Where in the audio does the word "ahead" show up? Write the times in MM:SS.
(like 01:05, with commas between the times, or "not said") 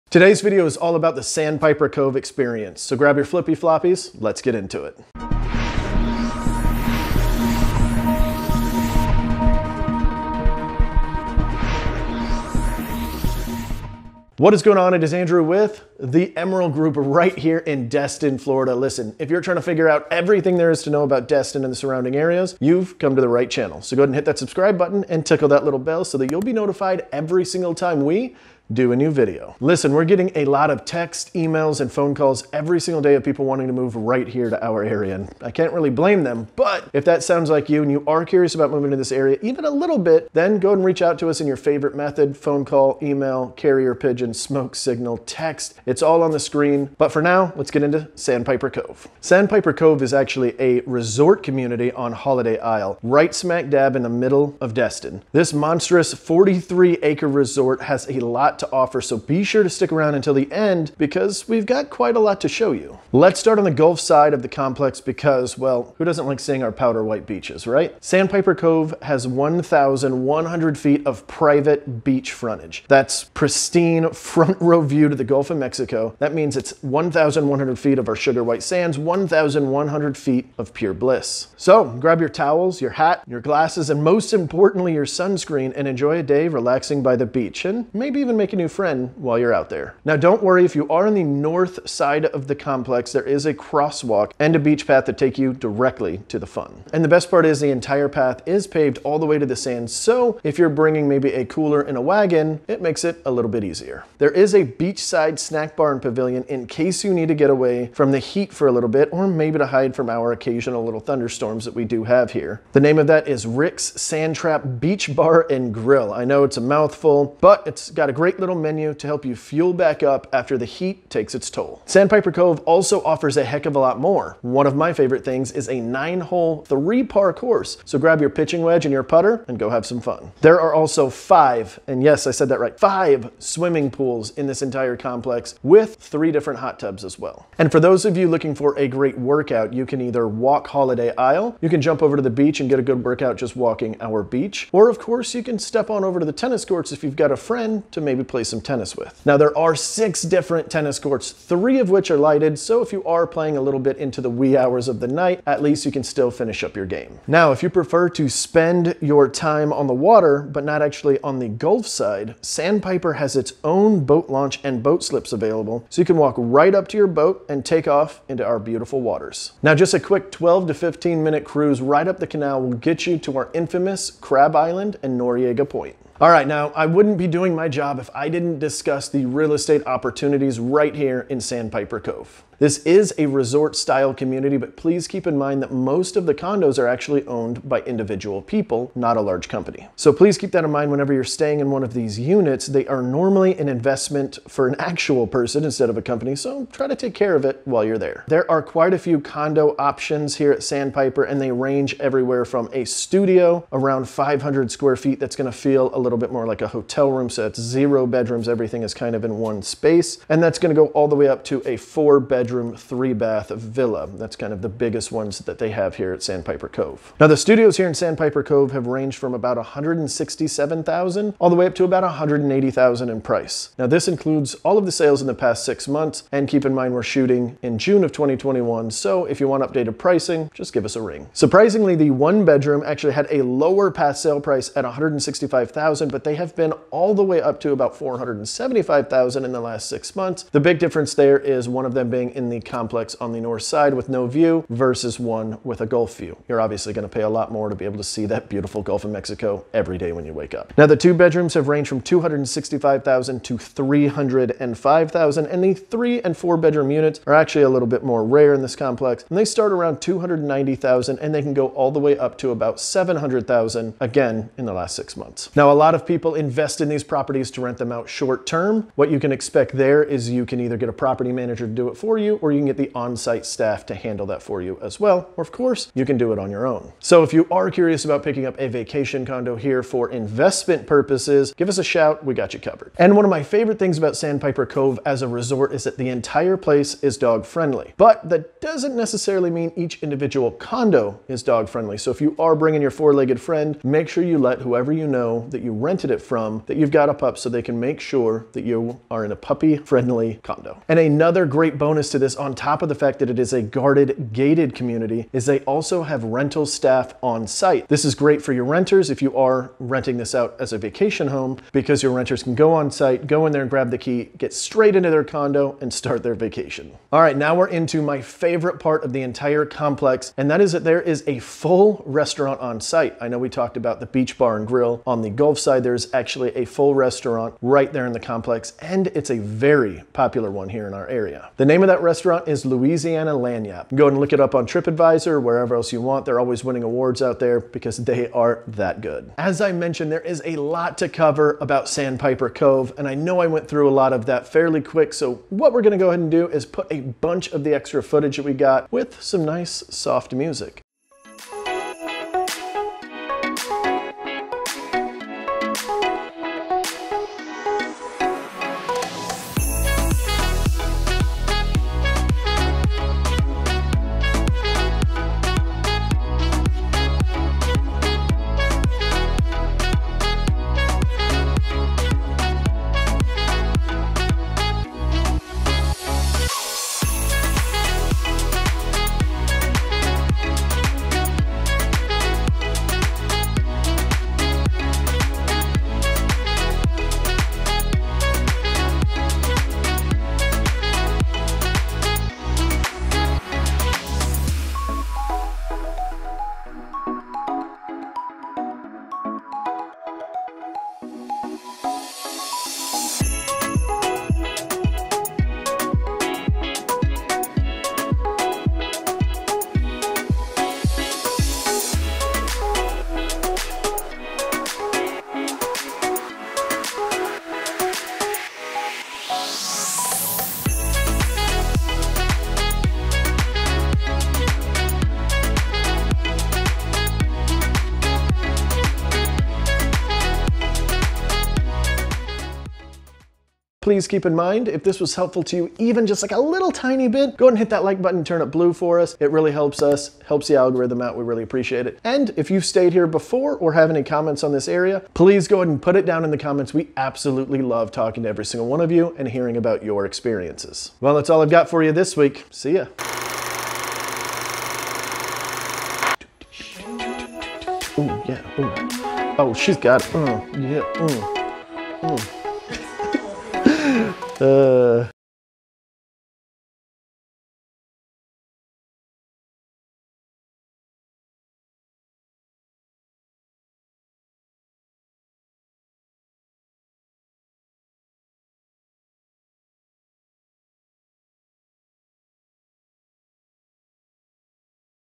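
00:24, 05:46, 07:17, 07:25.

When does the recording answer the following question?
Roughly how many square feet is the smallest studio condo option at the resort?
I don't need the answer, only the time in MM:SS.
03:24.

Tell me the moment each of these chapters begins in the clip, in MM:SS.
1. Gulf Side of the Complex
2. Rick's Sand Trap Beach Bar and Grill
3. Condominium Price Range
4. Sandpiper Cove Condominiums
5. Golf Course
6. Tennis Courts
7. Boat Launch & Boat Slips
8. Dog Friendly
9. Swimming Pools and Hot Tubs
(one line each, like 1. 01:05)
1. 01:03
2. 01:44
3. 02:56
4. 00:49
5. 02:02
6. 02:24
7. 02:37
8. 04:43
9. 02:12.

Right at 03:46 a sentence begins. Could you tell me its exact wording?
And keep in mind, we're shooting in June of 2021.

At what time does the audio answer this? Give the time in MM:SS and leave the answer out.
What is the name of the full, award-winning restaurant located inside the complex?
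05:32.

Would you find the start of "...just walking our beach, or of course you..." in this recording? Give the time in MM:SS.
02:23.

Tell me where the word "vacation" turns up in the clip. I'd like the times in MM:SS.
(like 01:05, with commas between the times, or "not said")
04:38, 05:10, 05:16.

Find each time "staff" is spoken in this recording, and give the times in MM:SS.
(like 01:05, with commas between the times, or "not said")
04:33, 05:06.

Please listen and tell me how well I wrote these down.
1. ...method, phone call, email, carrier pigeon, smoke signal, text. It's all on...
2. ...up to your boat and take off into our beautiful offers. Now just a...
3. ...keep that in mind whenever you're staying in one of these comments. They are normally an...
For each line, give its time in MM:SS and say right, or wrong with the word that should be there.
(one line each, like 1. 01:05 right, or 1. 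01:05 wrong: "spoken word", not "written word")
1. 00:41 right
2. 02:46 wrong: "waters", not "offers"
3. 03:10 wrong: "units", not "comments".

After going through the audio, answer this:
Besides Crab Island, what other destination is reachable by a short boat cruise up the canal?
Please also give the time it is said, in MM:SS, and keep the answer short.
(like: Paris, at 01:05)
Noriega Point, at 02:55.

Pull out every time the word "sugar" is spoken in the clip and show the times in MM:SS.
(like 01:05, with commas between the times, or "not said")
01:18.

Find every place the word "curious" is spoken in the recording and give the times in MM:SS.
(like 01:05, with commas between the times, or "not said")
00:38, 04:37.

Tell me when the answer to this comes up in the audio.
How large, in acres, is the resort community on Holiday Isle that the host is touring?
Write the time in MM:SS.
00:56.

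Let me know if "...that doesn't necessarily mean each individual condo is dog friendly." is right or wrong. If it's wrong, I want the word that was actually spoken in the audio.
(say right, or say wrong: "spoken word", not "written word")
right.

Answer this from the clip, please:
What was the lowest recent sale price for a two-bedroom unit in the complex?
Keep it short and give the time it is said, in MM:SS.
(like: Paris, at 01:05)
$265,000, at 04:12.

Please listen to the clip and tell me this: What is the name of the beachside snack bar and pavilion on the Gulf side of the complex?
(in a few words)
Rick's Sand Trap Beach Bar and Grill.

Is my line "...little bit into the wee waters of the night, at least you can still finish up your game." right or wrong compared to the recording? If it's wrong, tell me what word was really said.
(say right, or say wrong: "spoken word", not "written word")
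wrong: "hours", not "waters".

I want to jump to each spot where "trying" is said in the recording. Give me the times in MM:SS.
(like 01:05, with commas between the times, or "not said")
00:19.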